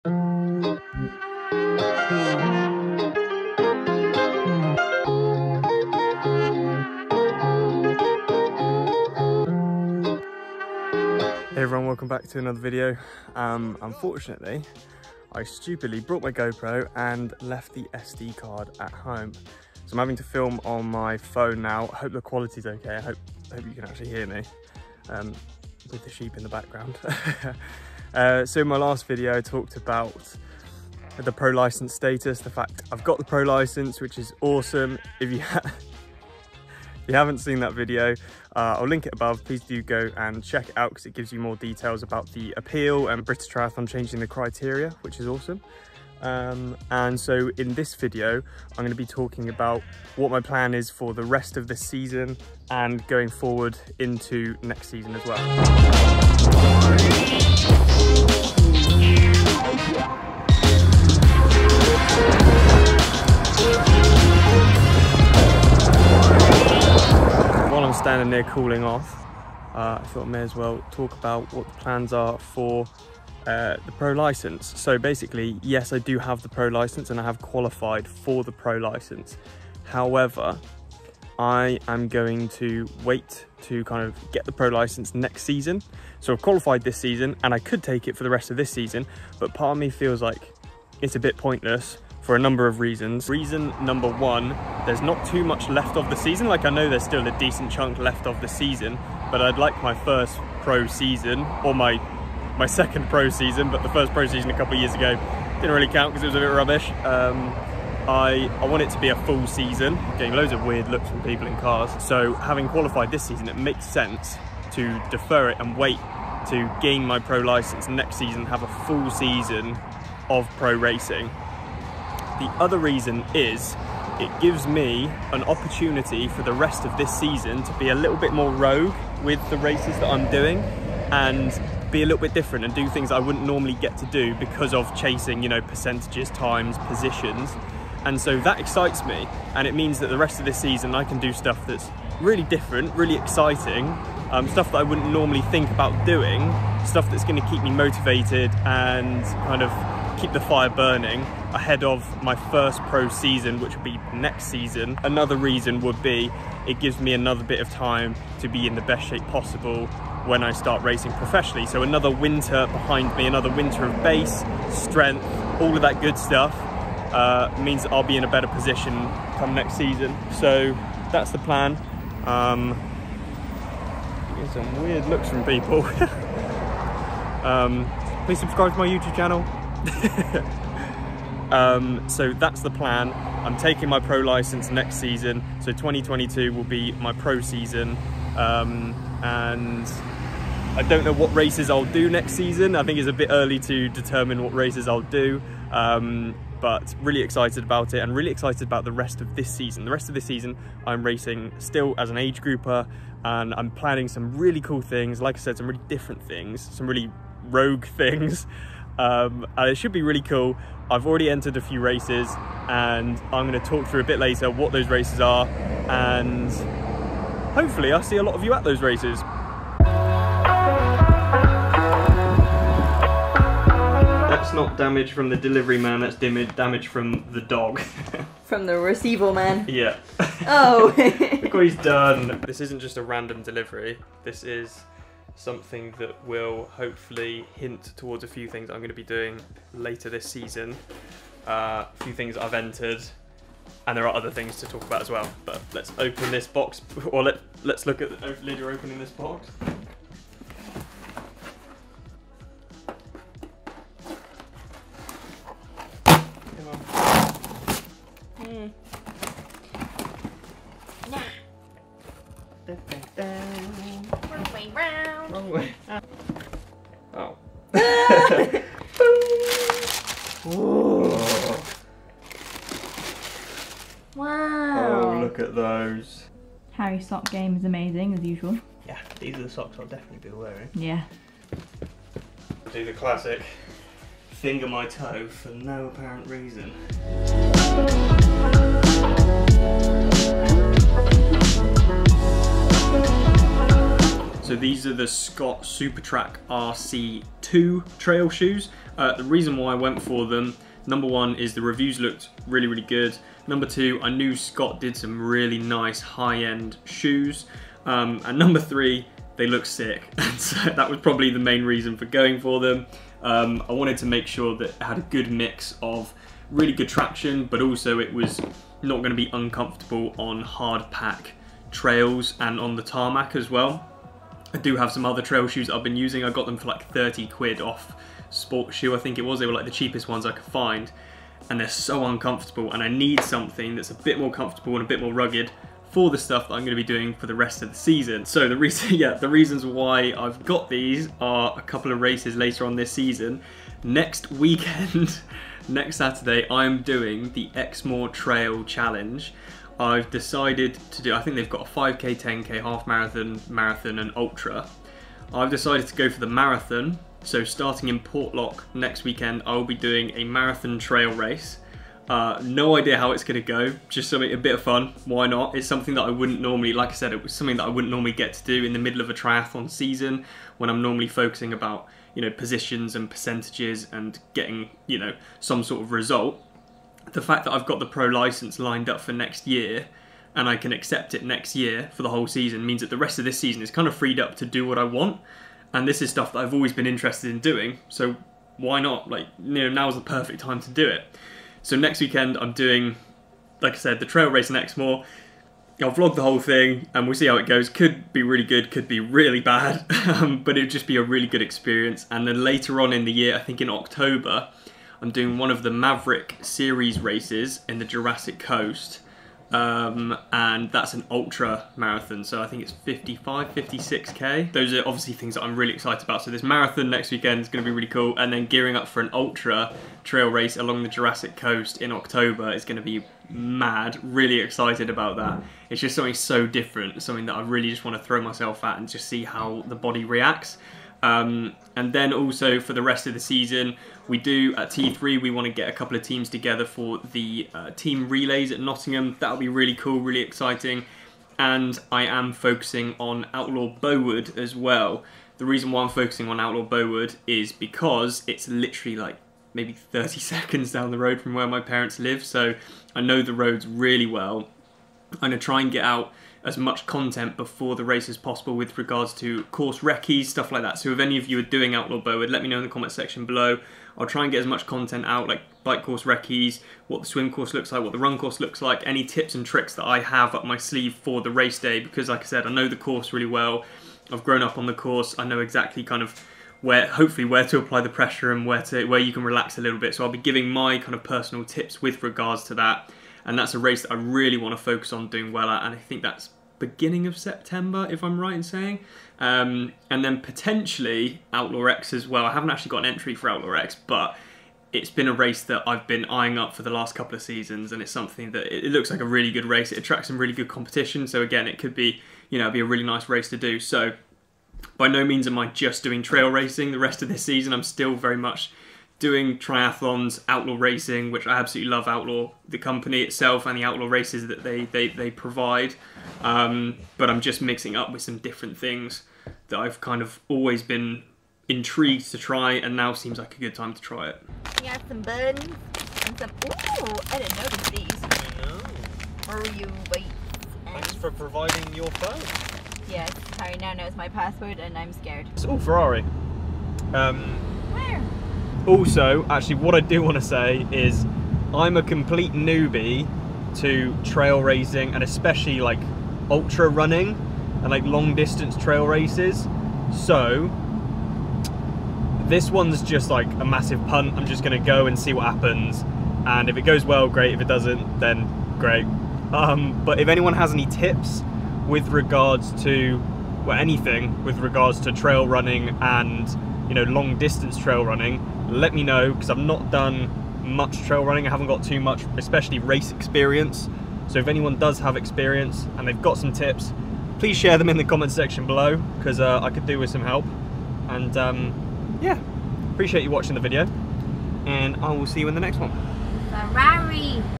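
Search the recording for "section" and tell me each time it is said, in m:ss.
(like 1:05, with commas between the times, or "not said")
7:42, 9:38.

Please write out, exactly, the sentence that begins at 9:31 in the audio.
I haven't got too much, especially race experience.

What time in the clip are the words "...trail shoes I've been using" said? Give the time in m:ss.
5:25.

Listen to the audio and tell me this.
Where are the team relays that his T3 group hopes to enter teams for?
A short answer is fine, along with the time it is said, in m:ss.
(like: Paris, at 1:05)
Nottingham, at 7:18.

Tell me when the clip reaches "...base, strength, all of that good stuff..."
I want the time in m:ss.
2:44.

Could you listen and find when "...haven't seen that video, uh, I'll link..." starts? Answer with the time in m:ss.
0:37.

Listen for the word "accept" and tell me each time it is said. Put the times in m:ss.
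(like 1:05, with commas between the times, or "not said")
6:20.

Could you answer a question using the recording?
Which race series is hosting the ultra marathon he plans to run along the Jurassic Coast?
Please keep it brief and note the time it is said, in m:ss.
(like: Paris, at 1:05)
Maverick, at 6:45.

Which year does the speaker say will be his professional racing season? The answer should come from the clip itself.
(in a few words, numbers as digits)
2022.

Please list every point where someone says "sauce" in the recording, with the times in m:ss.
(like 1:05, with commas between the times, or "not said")
not said.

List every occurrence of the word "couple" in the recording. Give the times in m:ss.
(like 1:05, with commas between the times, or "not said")
1:44, 5:41, 7:15, 8:16.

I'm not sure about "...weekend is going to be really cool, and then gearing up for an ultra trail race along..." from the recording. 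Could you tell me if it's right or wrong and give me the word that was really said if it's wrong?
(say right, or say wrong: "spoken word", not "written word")
right.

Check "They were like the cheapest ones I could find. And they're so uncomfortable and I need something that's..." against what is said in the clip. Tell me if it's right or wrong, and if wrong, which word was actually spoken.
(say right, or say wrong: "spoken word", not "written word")
right.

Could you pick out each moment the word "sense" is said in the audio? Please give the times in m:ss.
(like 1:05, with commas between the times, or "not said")
1:53.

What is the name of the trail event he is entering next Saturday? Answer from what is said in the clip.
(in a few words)
Exmoor Trail Challenge.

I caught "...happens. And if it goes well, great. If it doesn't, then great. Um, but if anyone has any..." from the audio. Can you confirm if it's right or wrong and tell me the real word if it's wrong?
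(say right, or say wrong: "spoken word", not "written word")
right.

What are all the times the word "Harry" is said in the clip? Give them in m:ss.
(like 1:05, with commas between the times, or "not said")
4:36, 8:53.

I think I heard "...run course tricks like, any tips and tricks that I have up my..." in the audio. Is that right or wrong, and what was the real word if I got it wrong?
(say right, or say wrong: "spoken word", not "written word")
wrong: "looks", not "tricks".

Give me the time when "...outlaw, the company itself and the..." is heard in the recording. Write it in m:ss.
8:31.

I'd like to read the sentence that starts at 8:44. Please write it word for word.
We have some buns and some, ooh, I didn't notice these.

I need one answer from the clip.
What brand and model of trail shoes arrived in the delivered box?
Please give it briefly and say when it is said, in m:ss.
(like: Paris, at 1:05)
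Scott Supertrac RC2, at 4:55.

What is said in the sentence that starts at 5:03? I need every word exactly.
Number two, I knew Scott did some really nice high-end shoes.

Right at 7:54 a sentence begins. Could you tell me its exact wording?
I've grown up on the course.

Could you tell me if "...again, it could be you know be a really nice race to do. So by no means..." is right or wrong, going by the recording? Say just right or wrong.
right.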